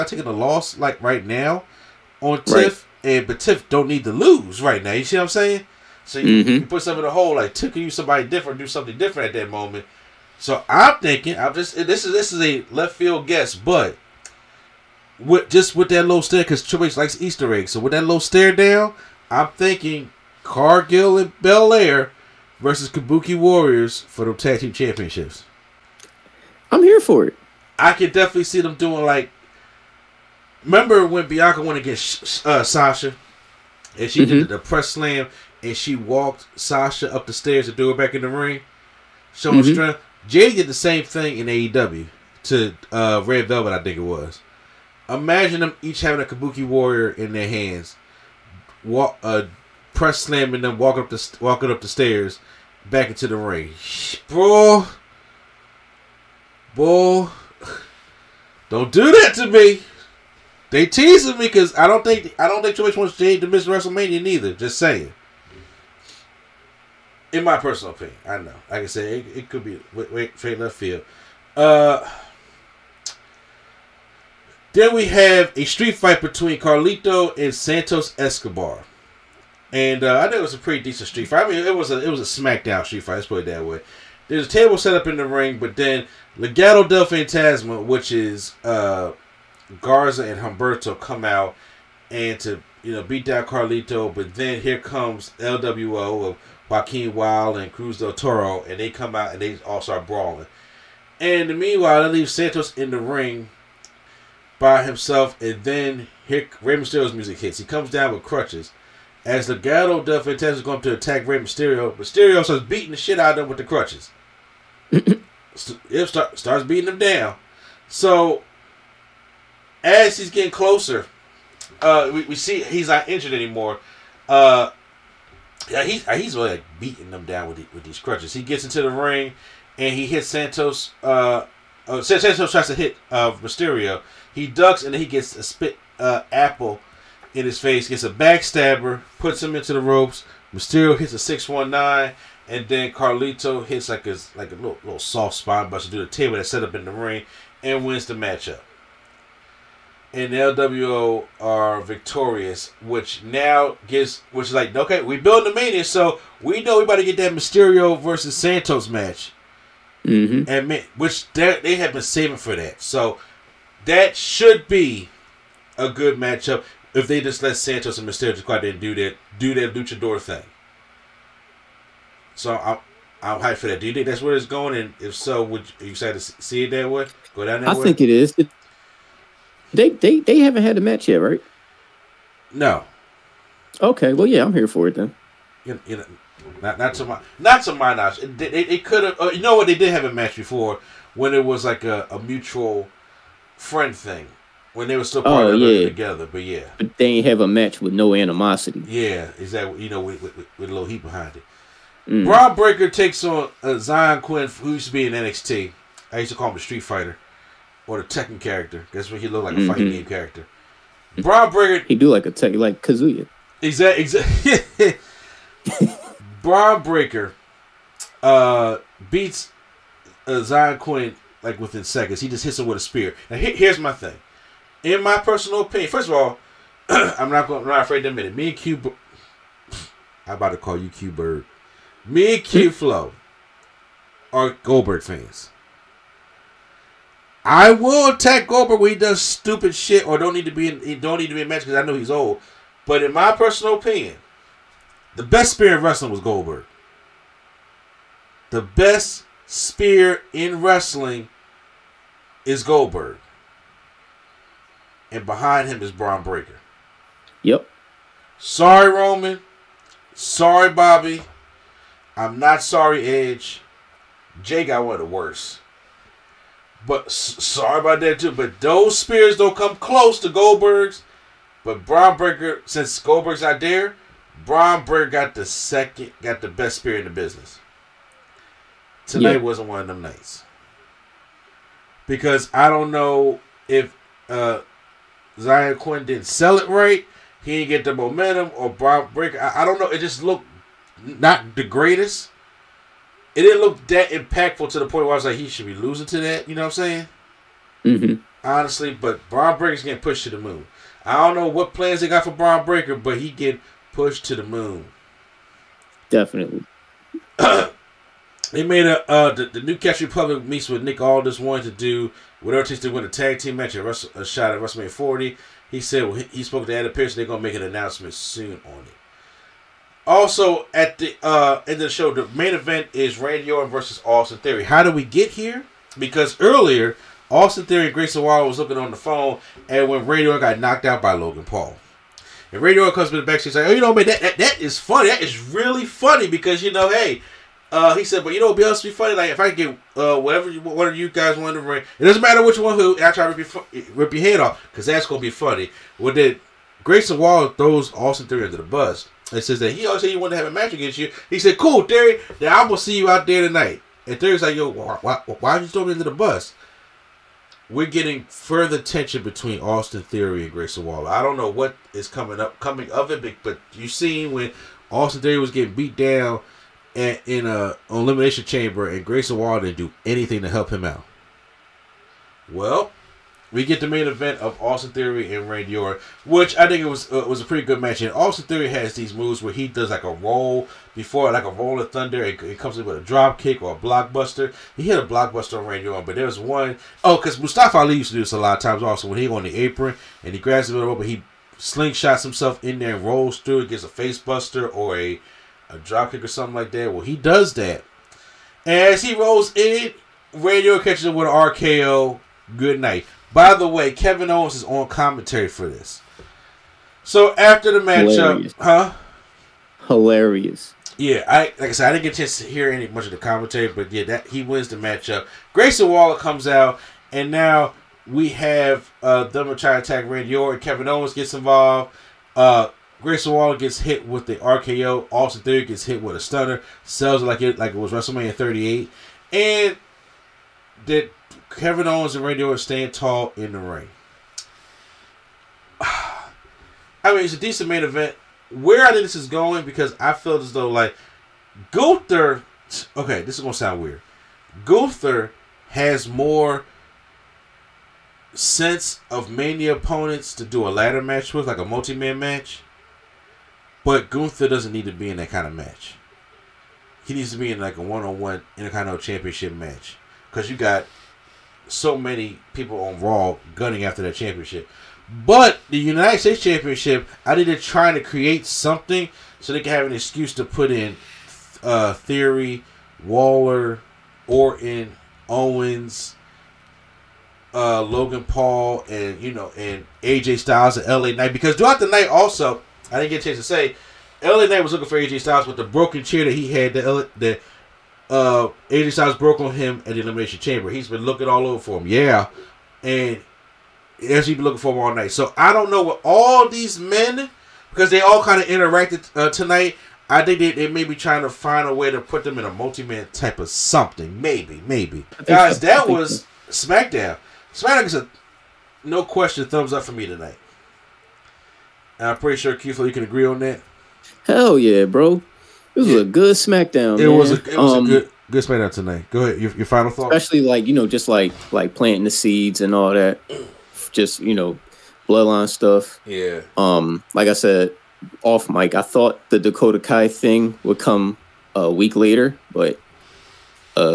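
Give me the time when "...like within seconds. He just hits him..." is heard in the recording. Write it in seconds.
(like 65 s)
221 s.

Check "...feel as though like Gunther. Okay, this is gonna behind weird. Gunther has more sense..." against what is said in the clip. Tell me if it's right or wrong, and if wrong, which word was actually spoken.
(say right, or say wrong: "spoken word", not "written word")
wrong: "sound", not "behind".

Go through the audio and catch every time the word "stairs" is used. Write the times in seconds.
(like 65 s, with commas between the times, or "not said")
37 s, 51 s.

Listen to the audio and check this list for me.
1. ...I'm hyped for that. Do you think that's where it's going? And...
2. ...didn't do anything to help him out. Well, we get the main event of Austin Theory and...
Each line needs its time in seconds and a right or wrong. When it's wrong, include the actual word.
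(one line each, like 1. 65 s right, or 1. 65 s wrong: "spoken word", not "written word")
1. 173 s right
2. 369 s right.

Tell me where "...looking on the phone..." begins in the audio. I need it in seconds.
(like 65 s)
328 s.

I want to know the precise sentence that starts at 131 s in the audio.
Uh, uh Santos tries to hit uh, Mysterio.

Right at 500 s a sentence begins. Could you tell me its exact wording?
I think they, they may be trying to find a way to put them in a multi man type of something.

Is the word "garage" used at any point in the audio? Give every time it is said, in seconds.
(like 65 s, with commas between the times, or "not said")
not said.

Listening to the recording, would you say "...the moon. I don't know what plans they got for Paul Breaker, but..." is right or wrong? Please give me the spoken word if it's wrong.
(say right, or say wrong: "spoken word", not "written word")
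wrong: "Braun", not "Paul".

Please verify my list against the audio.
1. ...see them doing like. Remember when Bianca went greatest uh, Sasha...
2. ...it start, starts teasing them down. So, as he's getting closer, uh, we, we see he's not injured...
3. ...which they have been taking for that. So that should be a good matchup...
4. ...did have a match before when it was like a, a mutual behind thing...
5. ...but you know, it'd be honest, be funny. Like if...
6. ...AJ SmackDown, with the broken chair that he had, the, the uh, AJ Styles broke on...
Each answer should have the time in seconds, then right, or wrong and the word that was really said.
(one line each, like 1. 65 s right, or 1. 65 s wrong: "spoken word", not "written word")
1. 28 s wrong: "against", not "greatest"
2. 114 s wrong: "beating", not "teasing"
3. 160 s wrong: "saving", not "taking"
4. 189 s wrong: "friend", not "behind"
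5. 338 s right
6. 484 s wrong: "Styles", not "SmackDown".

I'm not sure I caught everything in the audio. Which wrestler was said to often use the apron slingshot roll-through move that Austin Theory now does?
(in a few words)
Mustafa Ali.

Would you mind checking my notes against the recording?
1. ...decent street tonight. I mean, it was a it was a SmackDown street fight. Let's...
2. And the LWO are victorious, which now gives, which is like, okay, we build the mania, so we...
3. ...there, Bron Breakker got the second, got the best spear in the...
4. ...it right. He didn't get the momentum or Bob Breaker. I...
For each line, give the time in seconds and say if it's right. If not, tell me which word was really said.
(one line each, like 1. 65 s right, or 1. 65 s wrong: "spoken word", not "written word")
1. 80 s wrong: "fight", not "tonight"
2. 150 s right
3. 273 s right
4. 286 s right.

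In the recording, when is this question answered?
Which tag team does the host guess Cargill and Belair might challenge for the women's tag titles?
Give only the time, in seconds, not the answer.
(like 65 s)
22 s.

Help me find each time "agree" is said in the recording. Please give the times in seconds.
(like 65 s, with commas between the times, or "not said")
513 s.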